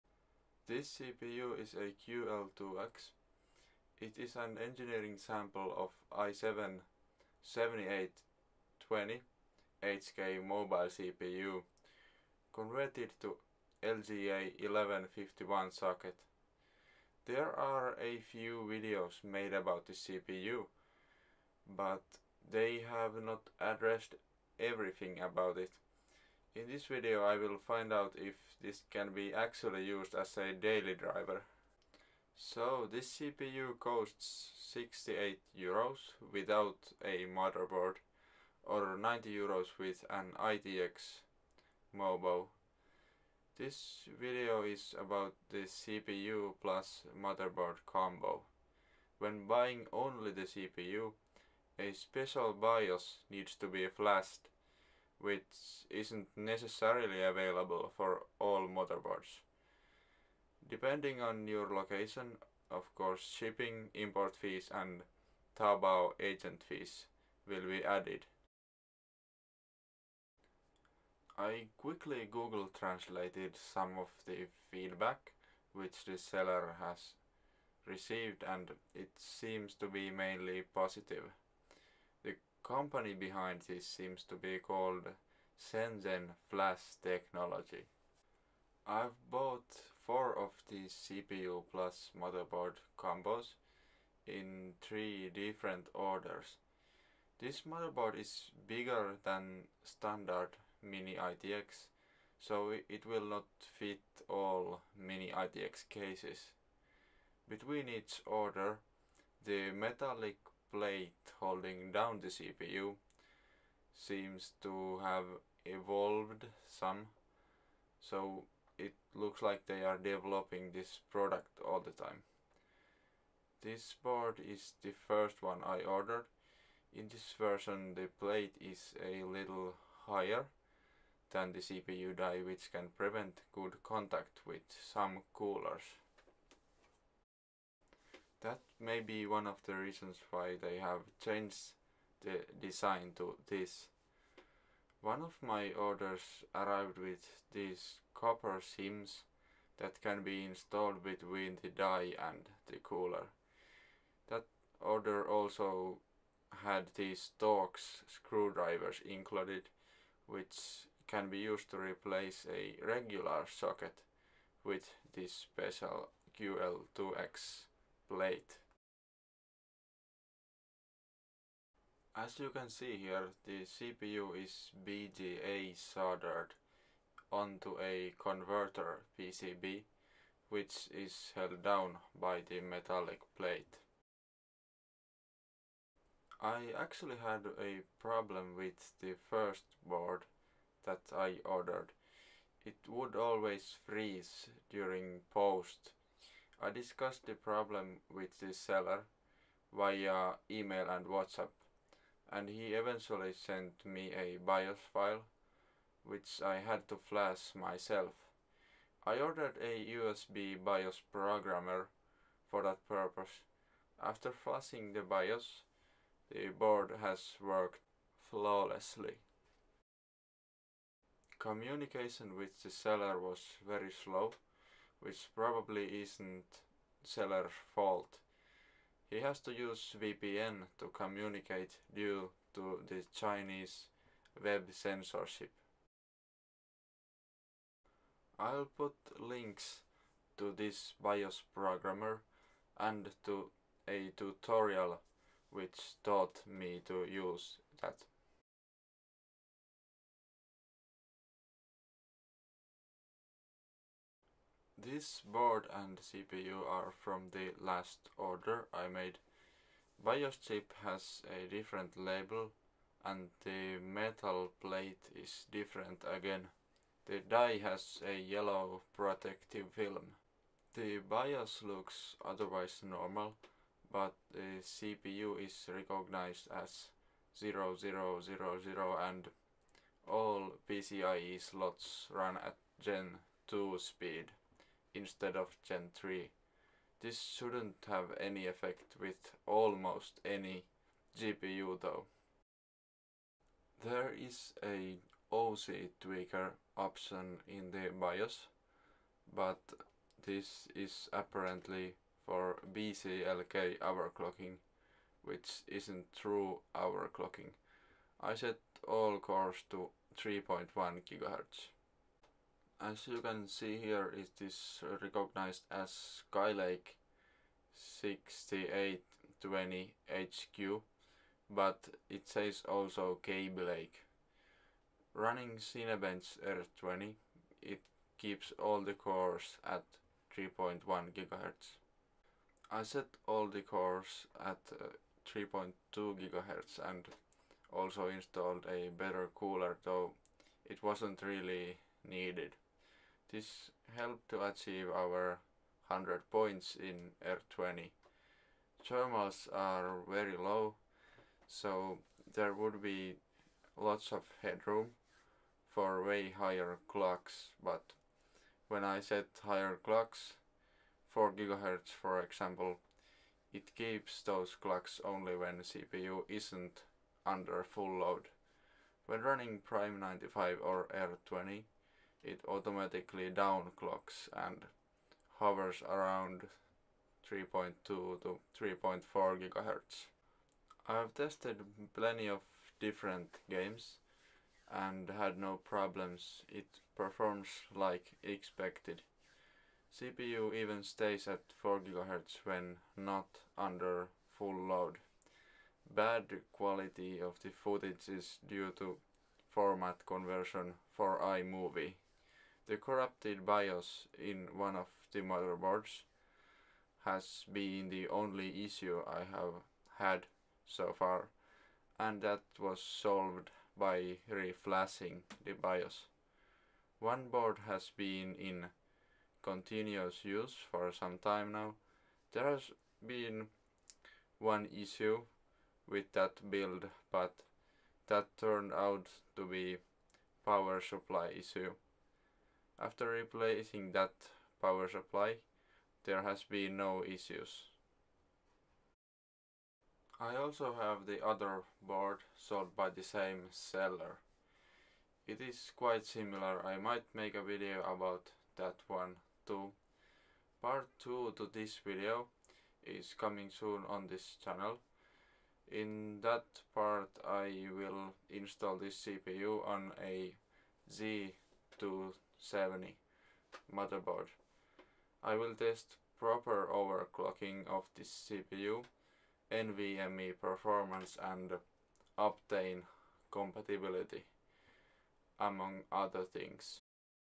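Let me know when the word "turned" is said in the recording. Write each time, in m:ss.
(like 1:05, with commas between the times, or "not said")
7:08.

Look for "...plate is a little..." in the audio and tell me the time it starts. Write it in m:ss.
2:08.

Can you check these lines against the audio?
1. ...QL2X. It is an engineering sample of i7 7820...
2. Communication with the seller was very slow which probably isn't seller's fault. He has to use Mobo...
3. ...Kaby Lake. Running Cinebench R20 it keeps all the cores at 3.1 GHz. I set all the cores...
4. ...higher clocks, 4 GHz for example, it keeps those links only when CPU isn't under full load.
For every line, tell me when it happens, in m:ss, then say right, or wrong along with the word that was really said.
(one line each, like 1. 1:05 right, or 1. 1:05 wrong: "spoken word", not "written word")
1. 0:02 right
2. 3:41 wrong: "VPN", not "Mobo"
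3. 5:23 right
4. 5:59 wrong: "clocks", not "links".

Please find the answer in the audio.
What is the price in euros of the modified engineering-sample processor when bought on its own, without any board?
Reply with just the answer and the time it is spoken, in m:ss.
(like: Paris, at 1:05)
68 euros, at 0:34.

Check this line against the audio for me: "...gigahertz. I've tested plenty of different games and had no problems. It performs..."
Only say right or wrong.
right.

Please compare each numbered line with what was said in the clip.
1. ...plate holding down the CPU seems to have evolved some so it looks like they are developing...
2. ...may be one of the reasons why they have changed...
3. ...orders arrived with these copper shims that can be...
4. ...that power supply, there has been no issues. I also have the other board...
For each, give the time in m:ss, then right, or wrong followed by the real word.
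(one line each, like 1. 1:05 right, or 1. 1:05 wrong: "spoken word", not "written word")
1. 1:50 right
2. 2:18 right
3. 2:25 right
4. 7:13 right.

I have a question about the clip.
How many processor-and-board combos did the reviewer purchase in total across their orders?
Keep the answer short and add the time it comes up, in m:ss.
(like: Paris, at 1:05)
4, at 1:30.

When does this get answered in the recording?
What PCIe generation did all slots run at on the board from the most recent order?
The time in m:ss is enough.
4:42.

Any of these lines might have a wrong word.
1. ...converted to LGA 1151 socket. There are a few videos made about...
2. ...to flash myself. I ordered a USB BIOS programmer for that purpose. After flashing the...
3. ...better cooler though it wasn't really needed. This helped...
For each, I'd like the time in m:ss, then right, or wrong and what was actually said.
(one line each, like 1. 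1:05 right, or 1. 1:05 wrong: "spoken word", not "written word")
1. 0:12 right
2. 3:26 right
3. 5:38 right.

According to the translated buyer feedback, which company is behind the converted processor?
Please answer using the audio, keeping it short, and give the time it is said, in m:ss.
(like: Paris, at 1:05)
Shenzhen Flash Technology, at 1:25.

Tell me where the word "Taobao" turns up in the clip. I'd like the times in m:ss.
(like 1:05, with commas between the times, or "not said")
1:05.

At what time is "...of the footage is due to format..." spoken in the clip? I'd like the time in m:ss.
6:37.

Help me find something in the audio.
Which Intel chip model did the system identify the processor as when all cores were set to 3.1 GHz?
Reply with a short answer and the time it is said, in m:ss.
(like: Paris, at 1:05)
6820 HQ, at 5:17.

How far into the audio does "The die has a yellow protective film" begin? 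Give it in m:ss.
4:27.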